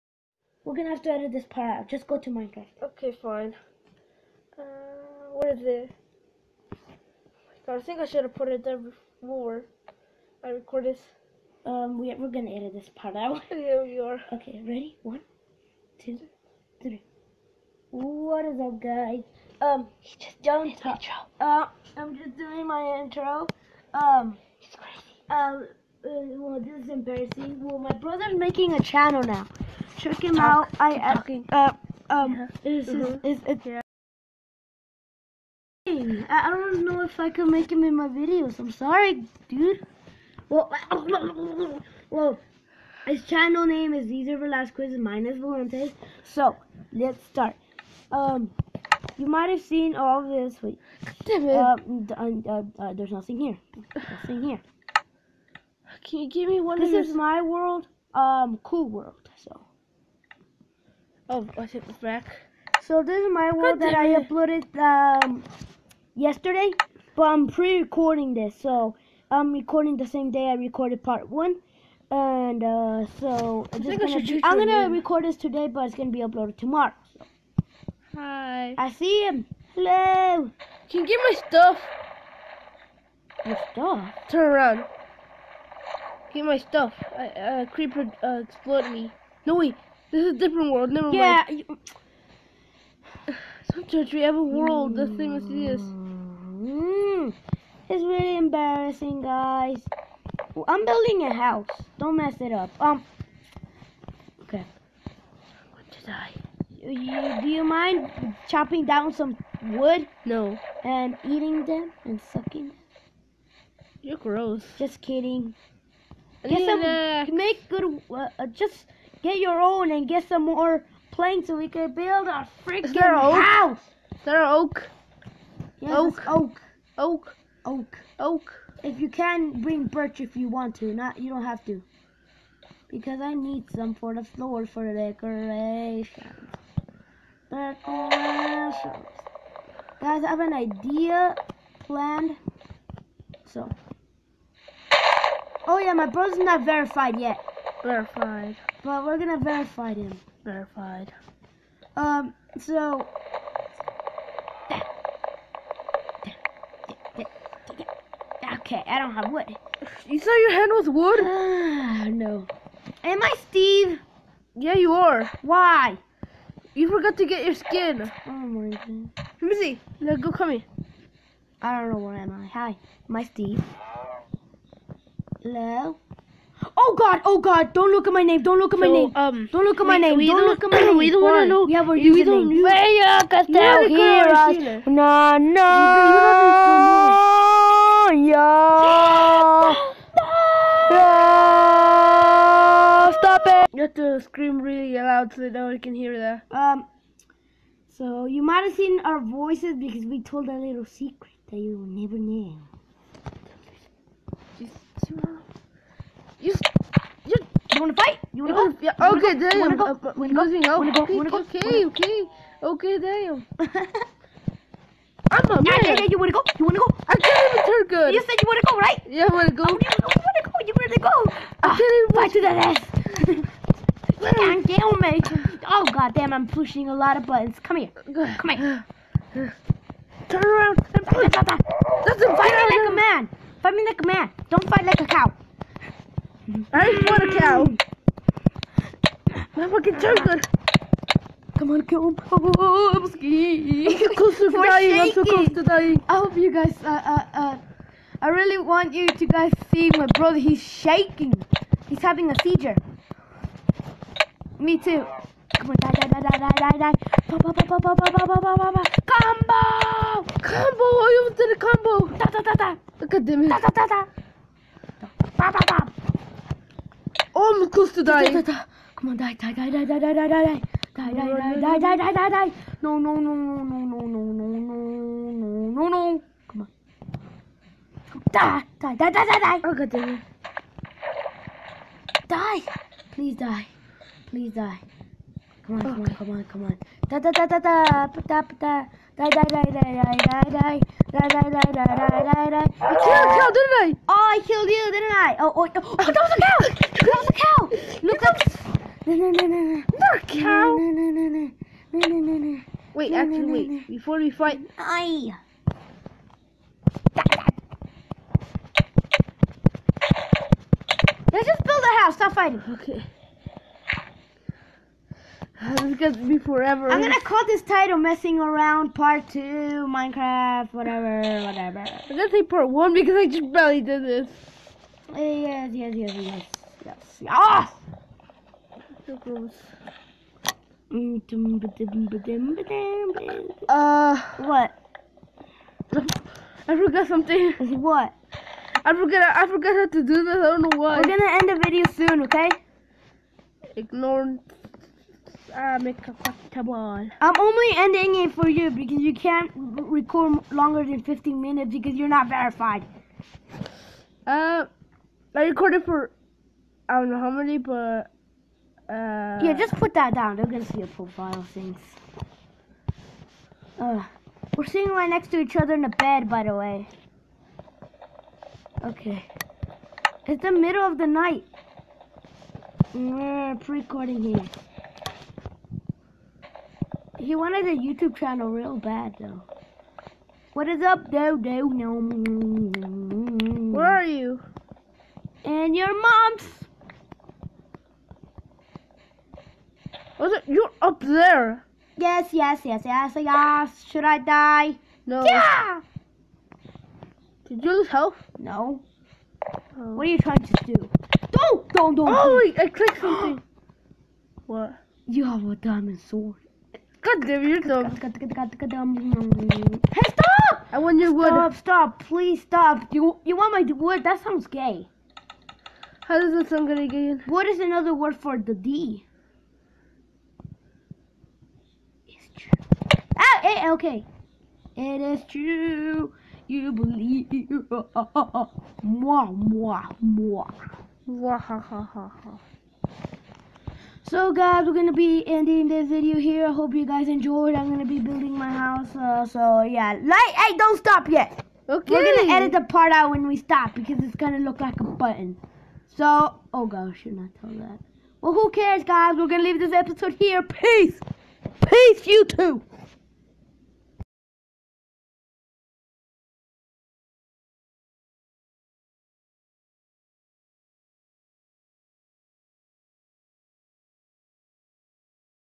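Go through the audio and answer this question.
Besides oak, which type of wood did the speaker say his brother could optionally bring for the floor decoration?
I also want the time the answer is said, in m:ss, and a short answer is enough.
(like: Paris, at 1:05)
Birch, at 2:09.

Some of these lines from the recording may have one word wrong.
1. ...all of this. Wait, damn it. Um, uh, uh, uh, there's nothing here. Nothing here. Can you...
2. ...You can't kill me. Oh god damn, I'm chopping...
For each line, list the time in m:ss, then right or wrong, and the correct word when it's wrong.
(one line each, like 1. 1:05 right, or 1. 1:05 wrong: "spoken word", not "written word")
1. 0:49 right
2. 3:44 wrong: "pushing", not "chopping".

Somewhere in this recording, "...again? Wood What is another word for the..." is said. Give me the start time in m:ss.
6:56.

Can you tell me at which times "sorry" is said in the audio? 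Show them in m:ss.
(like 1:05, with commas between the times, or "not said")
0:38.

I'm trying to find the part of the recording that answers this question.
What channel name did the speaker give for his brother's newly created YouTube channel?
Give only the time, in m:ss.
0:44.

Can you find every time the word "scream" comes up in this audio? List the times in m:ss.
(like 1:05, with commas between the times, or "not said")
3:14.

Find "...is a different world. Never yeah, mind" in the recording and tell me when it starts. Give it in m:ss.
1:30.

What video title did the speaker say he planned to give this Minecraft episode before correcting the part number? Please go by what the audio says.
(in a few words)
Messing Around Part Two Minecraft.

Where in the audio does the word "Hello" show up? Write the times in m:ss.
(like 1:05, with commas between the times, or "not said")
1:19, 2:55.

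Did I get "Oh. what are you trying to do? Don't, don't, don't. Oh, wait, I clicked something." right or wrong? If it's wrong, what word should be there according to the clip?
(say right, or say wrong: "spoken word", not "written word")
right.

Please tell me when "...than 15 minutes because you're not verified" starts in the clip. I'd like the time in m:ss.
5:50.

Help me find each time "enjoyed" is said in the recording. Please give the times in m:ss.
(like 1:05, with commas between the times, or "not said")
7:17.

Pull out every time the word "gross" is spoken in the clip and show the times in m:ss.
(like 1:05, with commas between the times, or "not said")
1:54, 5:29.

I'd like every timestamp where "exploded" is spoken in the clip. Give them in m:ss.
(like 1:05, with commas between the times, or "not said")
1:28.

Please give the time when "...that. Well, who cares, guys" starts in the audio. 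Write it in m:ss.
7:27.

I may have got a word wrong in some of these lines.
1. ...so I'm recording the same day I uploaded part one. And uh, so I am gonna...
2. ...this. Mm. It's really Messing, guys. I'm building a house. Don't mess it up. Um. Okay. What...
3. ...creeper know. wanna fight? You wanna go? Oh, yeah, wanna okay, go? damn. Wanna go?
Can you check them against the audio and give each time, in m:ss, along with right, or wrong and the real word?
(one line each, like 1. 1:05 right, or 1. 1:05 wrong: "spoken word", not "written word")
1. 1:08 wrong: "recorded", not "uploaded"
2. 1:35 wrong: "embarrassing", not "Messing"
3. 3:21 wrong: "never", not "creeper".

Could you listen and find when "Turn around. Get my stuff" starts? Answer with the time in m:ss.
1:24.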